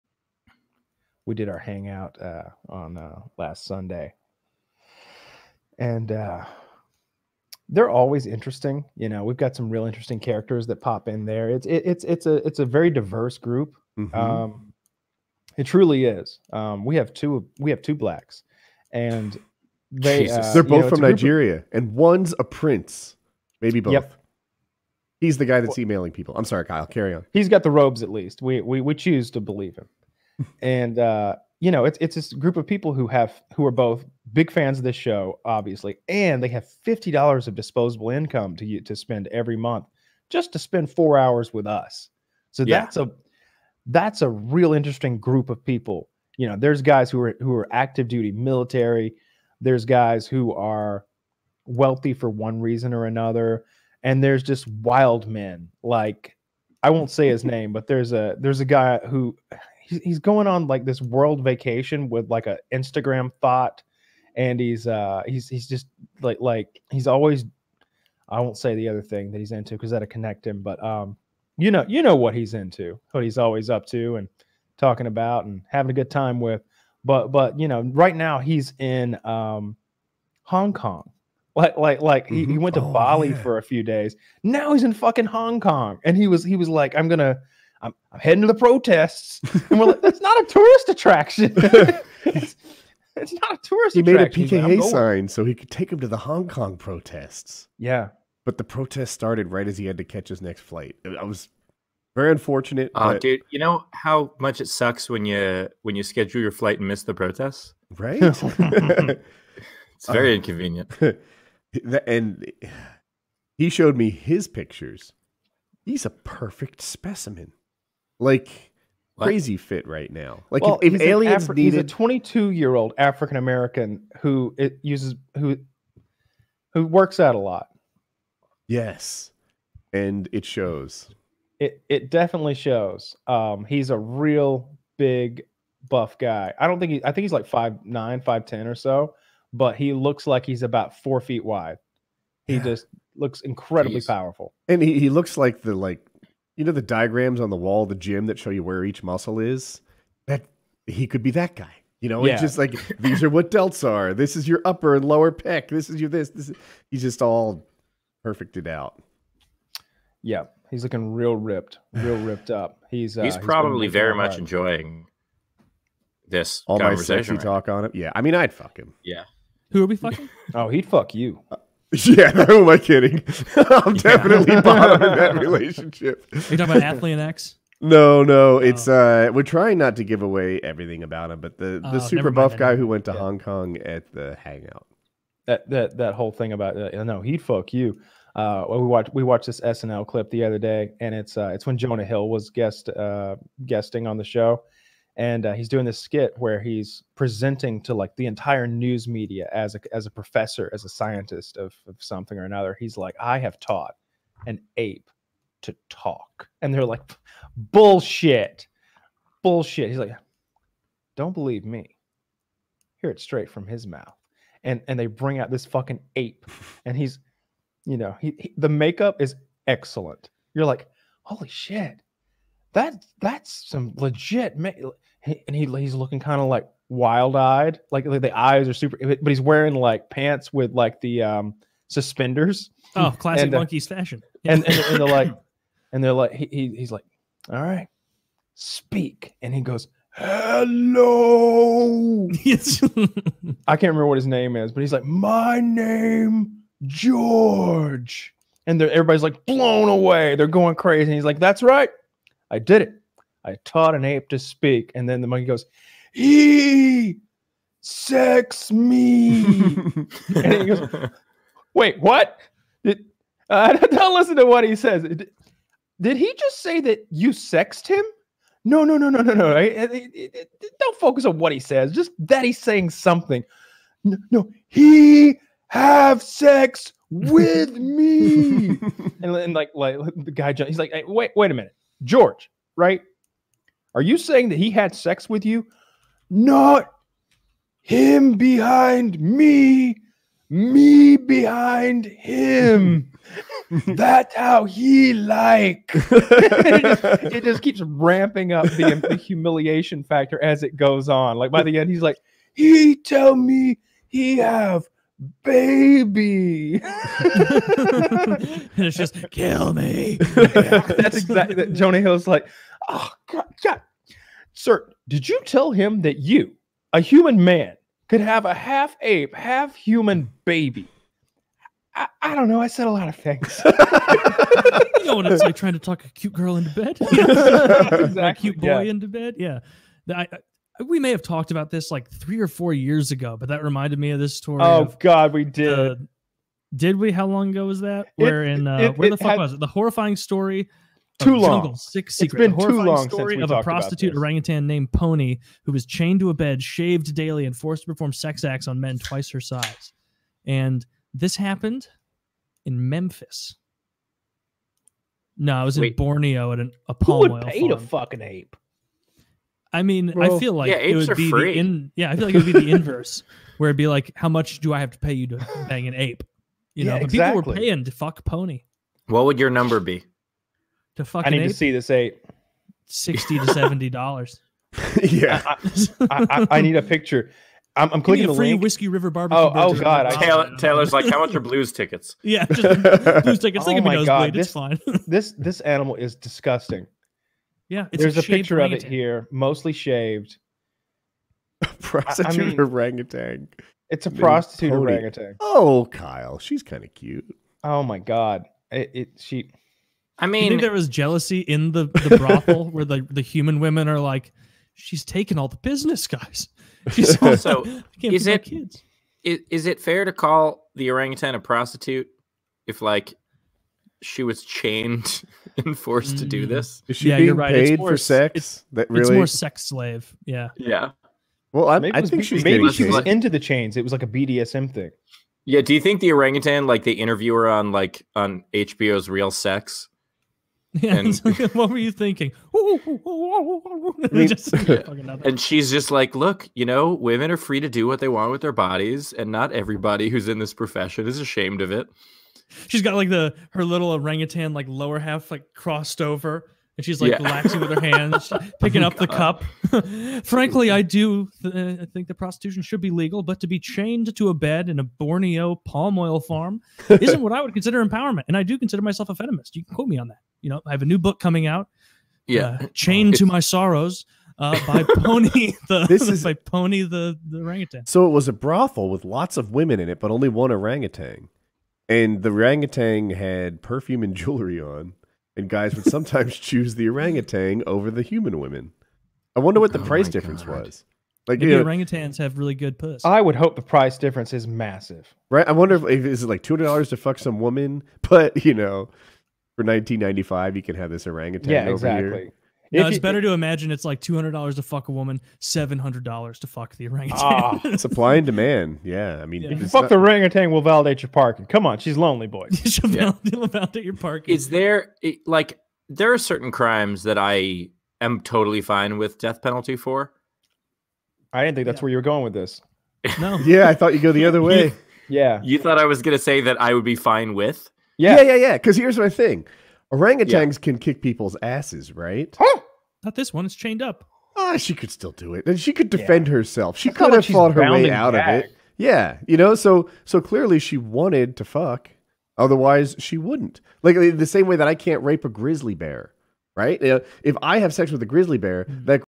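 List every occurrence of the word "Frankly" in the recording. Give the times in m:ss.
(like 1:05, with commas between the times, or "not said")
7:30.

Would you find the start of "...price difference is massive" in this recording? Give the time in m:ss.
8:03.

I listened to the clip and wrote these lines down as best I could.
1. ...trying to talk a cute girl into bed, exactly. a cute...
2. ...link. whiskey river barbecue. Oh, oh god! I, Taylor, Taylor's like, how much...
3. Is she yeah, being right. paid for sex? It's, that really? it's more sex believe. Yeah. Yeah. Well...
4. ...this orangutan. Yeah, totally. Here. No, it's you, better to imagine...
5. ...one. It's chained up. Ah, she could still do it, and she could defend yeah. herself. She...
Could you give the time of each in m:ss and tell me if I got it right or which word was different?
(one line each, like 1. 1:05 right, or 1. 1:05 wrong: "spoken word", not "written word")
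1. 5:25 right
2. 6:18 right
3. 6:56 wrong: "slave", not "believe"
4. 8:10 wrong: "exactly", not "totally"
5. 8:43 right.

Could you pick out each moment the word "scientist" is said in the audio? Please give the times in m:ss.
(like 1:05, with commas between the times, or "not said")
3:20.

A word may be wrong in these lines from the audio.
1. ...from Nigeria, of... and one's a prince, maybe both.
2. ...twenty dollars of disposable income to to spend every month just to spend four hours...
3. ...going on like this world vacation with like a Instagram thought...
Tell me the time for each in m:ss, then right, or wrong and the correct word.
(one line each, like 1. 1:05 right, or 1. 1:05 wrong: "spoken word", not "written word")
1. 0:20 right
2. 0:36 wrong: "fifty", not "twenty"
3. 1:00 right.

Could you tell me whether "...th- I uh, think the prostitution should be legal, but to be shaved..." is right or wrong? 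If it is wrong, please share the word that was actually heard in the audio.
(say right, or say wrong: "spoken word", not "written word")
wrong: "chained", not "shaved".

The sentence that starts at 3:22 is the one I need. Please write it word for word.
He's like, I have taught an ape to talk, and they're like, bullshit, bullshit.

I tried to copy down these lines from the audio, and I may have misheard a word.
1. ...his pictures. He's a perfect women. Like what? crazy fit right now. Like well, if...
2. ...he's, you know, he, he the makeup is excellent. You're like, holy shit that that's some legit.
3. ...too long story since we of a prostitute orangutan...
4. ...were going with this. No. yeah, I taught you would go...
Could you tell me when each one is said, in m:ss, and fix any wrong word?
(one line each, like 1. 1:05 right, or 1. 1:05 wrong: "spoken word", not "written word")
1. 1:54 wrong: "specimen", not "women"
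2. 3:36 right
3. 5:42 right
4. 8:31 wrong: "thought", not "taught".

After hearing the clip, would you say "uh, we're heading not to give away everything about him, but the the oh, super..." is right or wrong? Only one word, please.
wrong.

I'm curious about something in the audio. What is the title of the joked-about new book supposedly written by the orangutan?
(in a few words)
Chained to My Sorrows.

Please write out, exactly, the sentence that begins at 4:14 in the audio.
And then the monkey goes, he sex me.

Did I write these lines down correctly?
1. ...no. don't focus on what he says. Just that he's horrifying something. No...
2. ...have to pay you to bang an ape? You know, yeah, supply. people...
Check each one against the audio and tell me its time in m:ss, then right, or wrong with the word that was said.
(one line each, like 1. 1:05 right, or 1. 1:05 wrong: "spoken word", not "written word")
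1. 4:29 wrong: "saying", not "horrifying"
2. 6:04 wrong: "exactly", not "supply".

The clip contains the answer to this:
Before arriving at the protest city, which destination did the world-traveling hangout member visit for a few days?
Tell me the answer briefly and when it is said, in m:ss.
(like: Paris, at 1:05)
Bali, at 1:22.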